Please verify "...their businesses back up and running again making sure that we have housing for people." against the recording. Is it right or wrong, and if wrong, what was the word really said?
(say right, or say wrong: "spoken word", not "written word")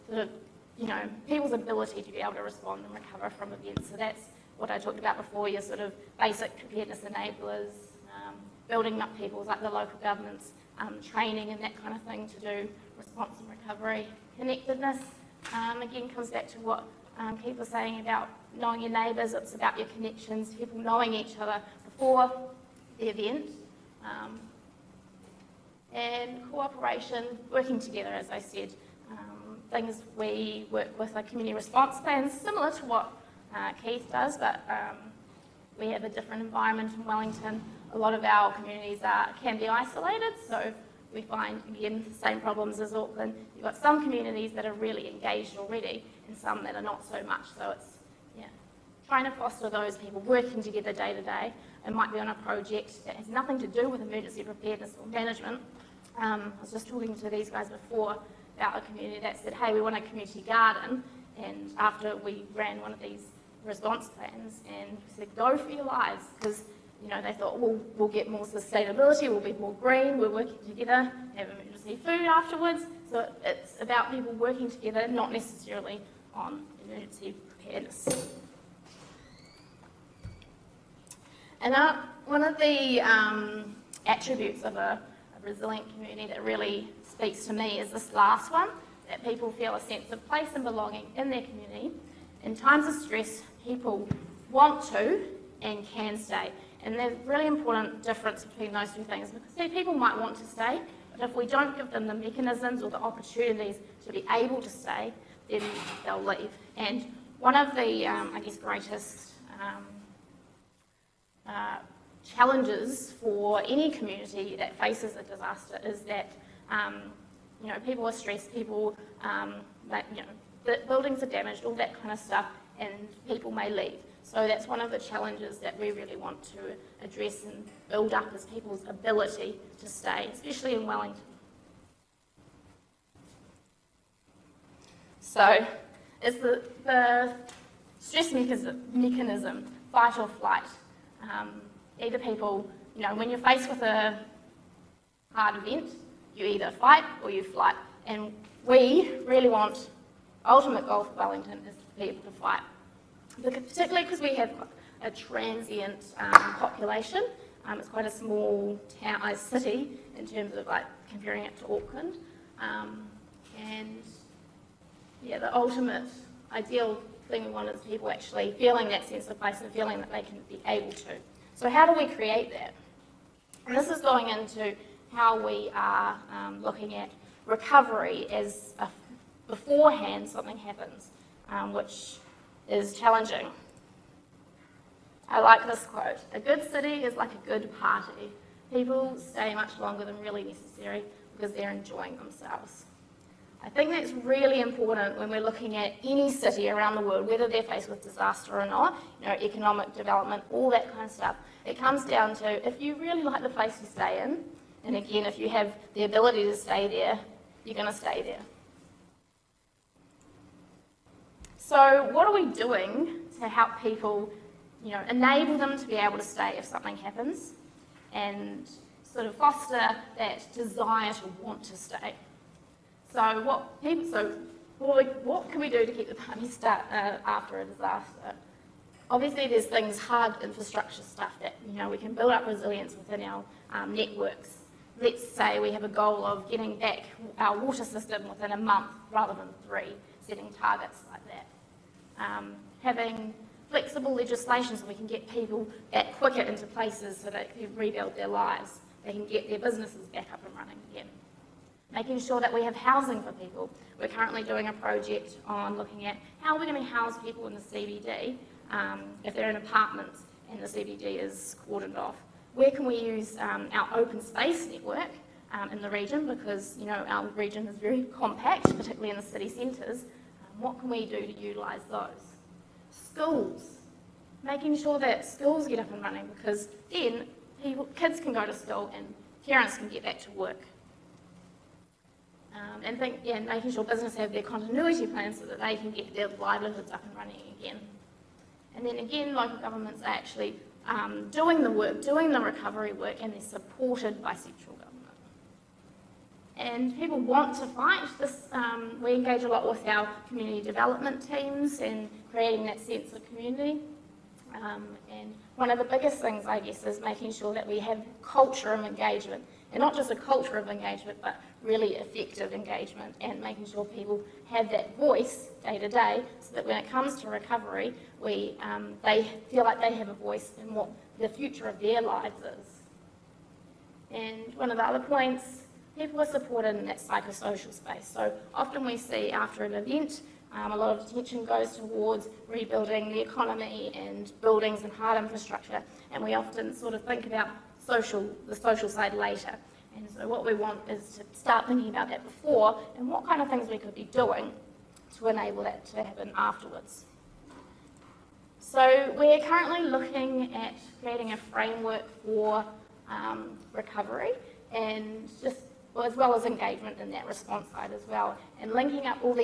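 right.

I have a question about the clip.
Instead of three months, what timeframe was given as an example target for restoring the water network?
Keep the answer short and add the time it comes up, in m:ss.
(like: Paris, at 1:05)
a month, at 3:58.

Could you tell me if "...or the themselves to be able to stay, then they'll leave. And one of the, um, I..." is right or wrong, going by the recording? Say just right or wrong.
wrong.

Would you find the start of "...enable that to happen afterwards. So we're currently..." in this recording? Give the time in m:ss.
5:45.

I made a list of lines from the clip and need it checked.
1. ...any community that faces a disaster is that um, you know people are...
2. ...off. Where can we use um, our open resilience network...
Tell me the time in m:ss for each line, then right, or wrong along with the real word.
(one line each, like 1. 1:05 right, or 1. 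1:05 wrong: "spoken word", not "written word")
1. 1:53 right
2. 4:21 wrong: "space", not "resilience".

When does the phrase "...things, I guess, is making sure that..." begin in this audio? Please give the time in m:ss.
5:06.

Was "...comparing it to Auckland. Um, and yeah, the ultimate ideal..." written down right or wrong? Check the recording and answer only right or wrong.
right.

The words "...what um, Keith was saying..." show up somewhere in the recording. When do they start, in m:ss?
0:16.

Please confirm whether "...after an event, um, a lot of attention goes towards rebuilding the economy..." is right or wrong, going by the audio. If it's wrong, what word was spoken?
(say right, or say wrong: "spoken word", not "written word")
right.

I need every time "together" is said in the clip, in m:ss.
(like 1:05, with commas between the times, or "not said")
0:27, 0:50, 1:10, 1:14.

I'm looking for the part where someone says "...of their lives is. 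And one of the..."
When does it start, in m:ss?
5:21.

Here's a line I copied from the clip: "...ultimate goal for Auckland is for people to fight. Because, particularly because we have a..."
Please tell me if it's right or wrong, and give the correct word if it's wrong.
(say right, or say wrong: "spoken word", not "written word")
wrong: "Wellington", not "Auckland".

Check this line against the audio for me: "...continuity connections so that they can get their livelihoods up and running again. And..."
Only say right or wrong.
wrong.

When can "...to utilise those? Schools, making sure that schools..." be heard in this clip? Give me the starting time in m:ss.
4:31.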